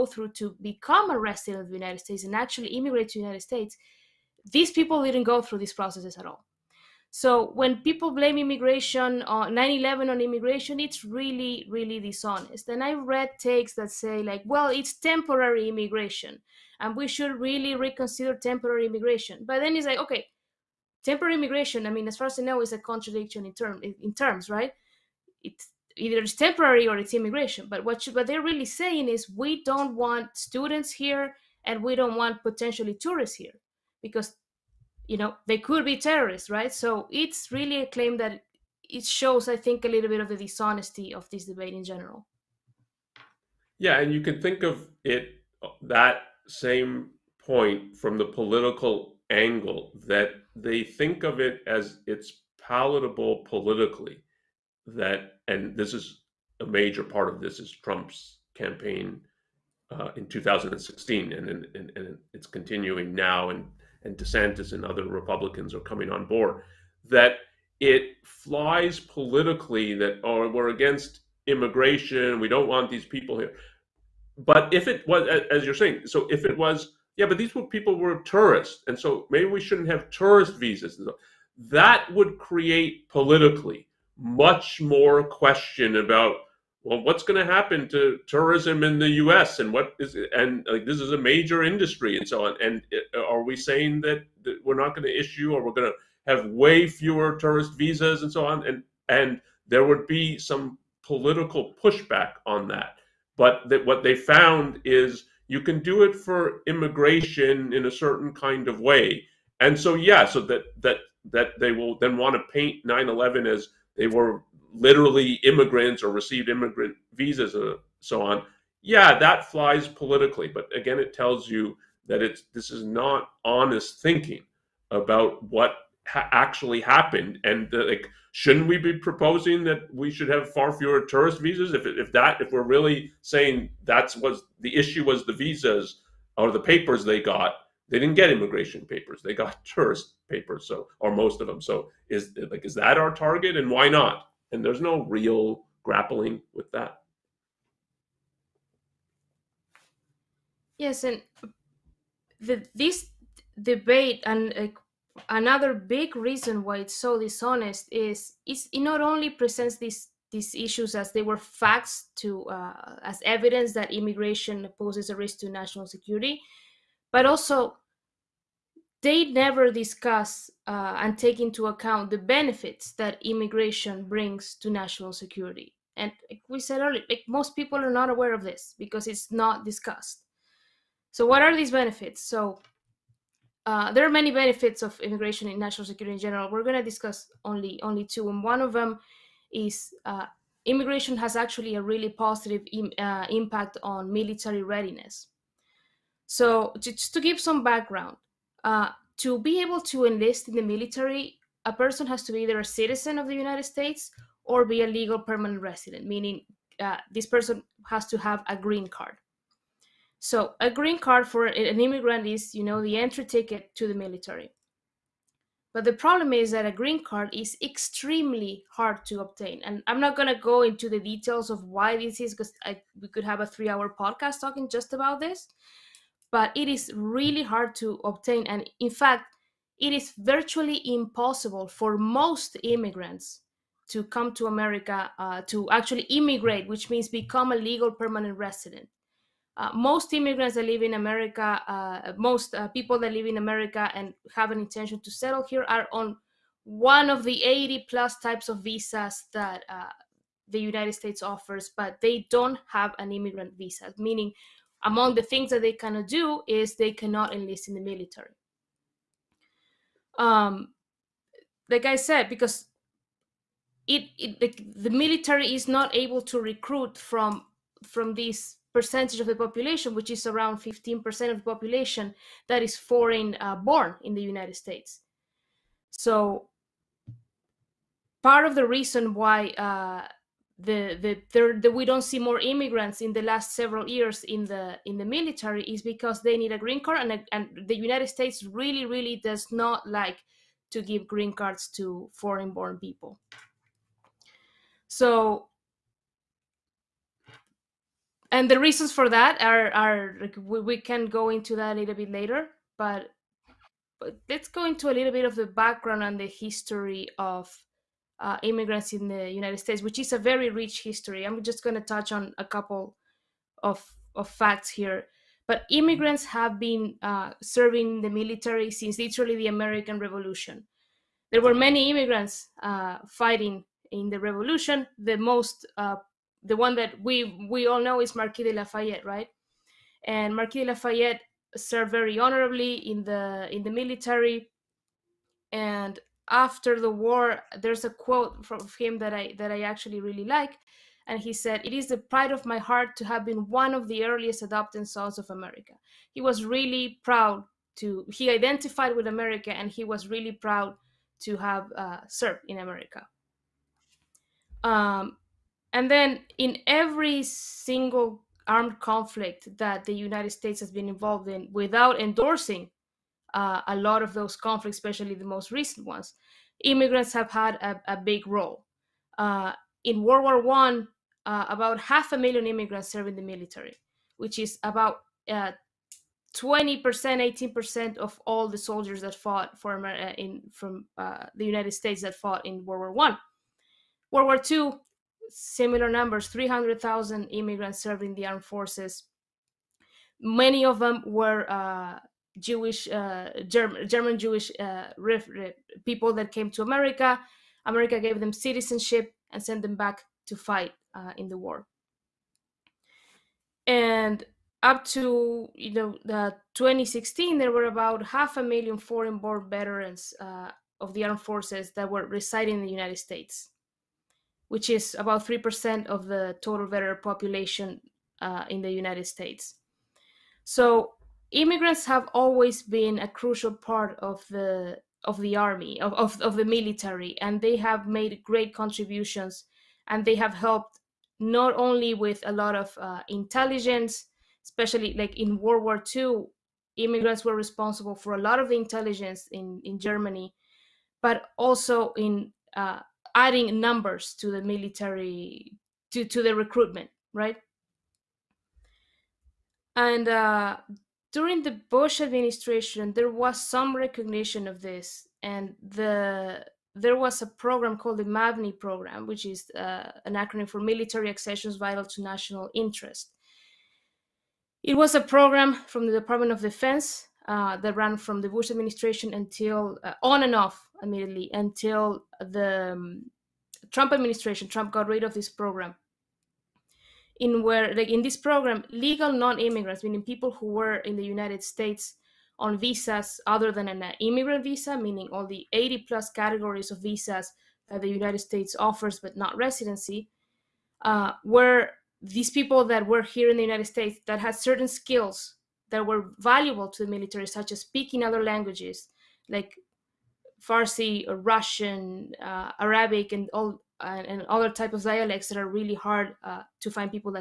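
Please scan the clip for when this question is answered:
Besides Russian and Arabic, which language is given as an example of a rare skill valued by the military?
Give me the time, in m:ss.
8:20.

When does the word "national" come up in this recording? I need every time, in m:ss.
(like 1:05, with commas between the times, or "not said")
2:45, 2:54, 3:05, 7:42.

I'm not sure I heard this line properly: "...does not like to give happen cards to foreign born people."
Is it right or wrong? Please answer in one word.
wrong.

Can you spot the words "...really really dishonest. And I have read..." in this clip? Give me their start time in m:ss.
0:11.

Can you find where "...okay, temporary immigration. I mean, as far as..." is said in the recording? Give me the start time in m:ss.
0:19.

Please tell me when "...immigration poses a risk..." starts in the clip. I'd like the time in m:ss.
2:43.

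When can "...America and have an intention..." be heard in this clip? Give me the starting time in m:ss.
4:03.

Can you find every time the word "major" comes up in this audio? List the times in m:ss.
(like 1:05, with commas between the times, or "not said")
0:56, 1:31.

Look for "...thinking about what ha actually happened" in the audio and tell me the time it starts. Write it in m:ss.
2:04.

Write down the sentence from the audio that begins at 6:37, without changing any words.
America gave them citizenship and sent them back to fight uh, in the war.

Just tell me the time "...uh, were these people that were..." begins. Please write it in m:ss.
8:10.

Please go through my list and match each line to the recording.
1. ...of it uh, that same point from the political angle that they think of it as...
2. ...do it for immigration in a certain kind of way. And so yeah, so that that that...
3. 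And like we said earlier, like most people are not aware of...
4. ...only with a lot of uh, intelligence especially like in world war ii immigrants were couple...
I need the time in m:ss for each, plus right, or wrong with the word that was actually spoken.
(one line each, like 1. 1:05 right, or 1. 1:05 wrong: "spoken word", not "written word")
1. 0:44 right
2. 1:45 right
3. 2:55 right
4. 7:11 wrong: "responsible", not "couple".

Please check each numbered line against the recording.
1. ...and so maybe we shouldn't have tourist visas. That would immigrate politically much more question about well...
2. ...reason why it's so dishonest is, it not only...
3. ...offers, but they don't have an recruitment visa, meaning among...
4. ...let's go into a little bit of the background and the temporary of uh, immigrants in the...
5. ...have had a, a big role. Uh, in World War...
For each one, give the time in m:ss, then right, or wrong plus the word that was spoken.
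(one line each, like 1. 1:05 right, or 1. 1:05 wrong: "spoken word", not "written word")
1. 1:18 wrong: "create", not "immigrate"
2. 2:36 right
3. 4:11 wrong: "immigrant", not "recruitment"
4. 5:04 wrong: "history", not "temporary"
5. 6:07 right.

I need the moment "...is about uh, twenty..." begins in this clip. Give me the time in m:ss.
6:14.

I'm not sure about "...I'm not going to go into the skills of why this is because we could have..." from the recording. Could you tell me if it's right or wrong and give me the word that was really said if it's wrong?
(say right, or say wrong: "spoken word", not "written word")
wrong: "details", not "skills".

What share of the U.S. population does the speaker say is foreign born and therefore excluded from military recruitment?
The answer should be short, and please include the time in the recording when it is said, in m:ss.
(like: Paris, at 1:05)
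15%, at 4:30.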